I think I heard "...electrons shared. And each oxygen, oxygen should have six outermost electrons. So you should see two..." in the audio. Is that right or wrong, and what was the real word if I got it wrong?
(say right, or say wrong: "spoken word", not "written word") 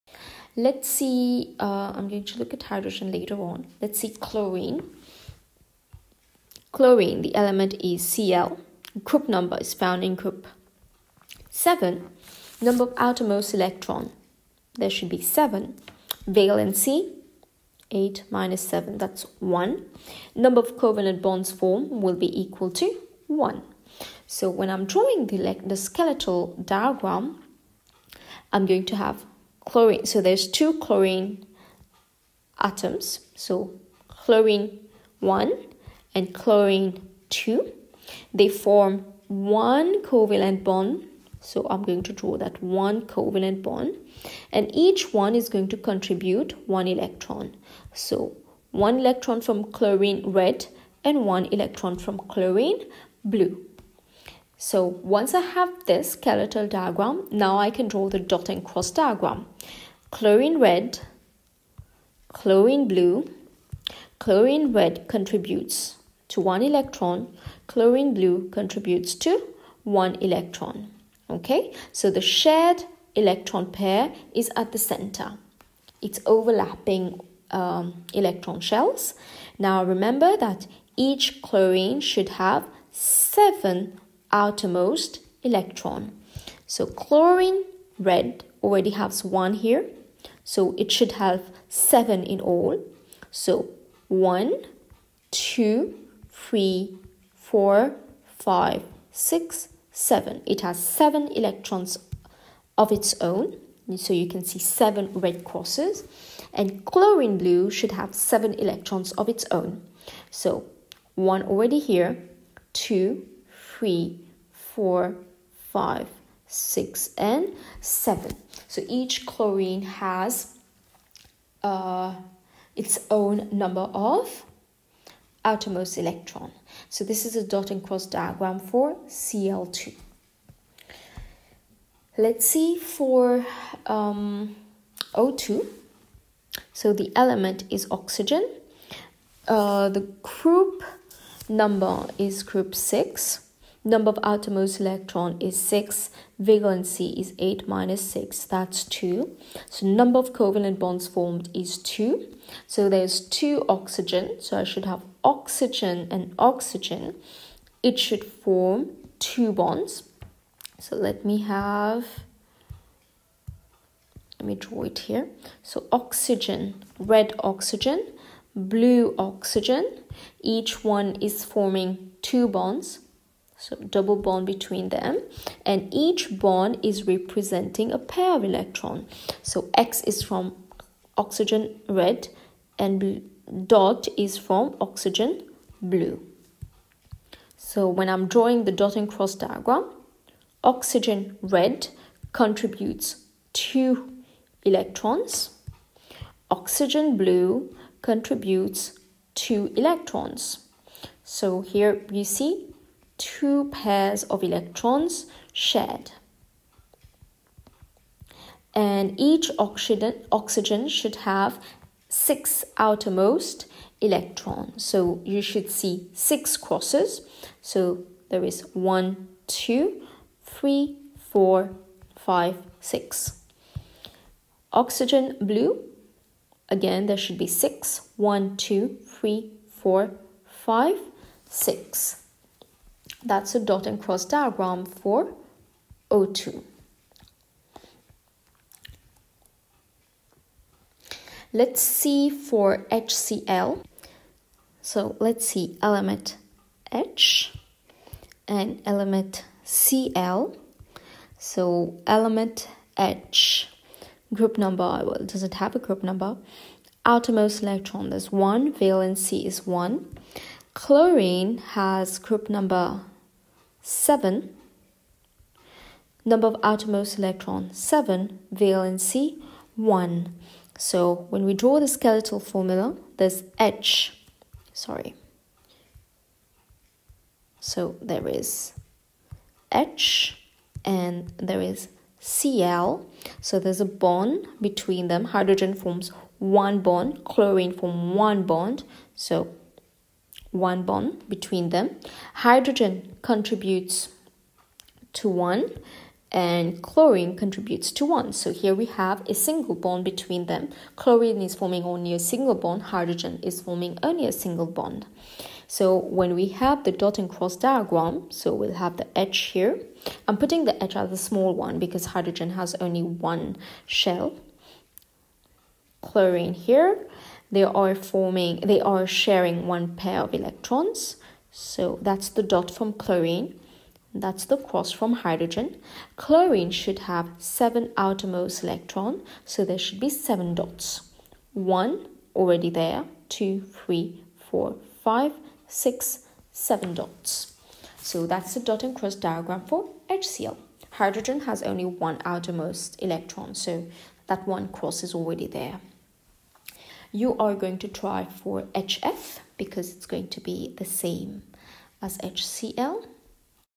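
wrong: "six", not "two".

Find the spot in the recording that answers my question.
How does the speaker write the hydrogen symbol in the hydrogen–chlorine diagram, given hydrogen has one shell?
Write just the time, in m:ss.
5:10.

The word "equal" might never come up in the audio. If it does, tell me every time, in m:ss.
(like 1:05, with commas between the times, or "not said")
0:22.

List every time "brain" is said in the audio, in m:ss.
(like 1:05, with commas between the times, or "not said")
not said.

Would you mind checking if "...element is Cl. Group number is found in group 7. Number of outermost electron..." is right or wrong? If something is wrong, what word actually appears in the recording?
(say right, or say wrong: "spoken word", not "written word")
right.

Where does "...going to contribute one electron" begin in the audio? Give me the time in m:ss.
0:45.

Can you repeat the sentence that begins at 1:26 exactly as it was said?
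So chlorine red already has one here.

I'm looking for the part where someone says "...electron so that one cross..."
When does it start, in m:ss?
5:43.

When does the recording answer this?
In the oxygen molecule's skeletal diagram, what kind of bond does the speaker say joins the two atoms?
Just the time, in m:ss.
2:53.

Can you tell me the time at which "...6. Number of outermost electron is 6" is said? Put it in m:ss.
2:22.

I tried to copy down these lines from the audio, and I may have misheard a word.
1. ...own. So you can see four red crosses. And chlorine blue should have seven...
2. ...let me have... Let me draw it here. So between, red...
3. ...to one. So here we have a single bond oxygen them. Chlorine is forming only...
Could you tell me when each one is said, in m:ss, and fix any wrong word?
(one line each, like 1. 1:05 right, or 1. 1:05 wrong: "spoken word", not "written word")
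1. 1:43 wrong: "seven", not "four"
2. 2:40 wrong: "oxygen", not "between"
3. 4:57 wrong: "between", not "oxygen".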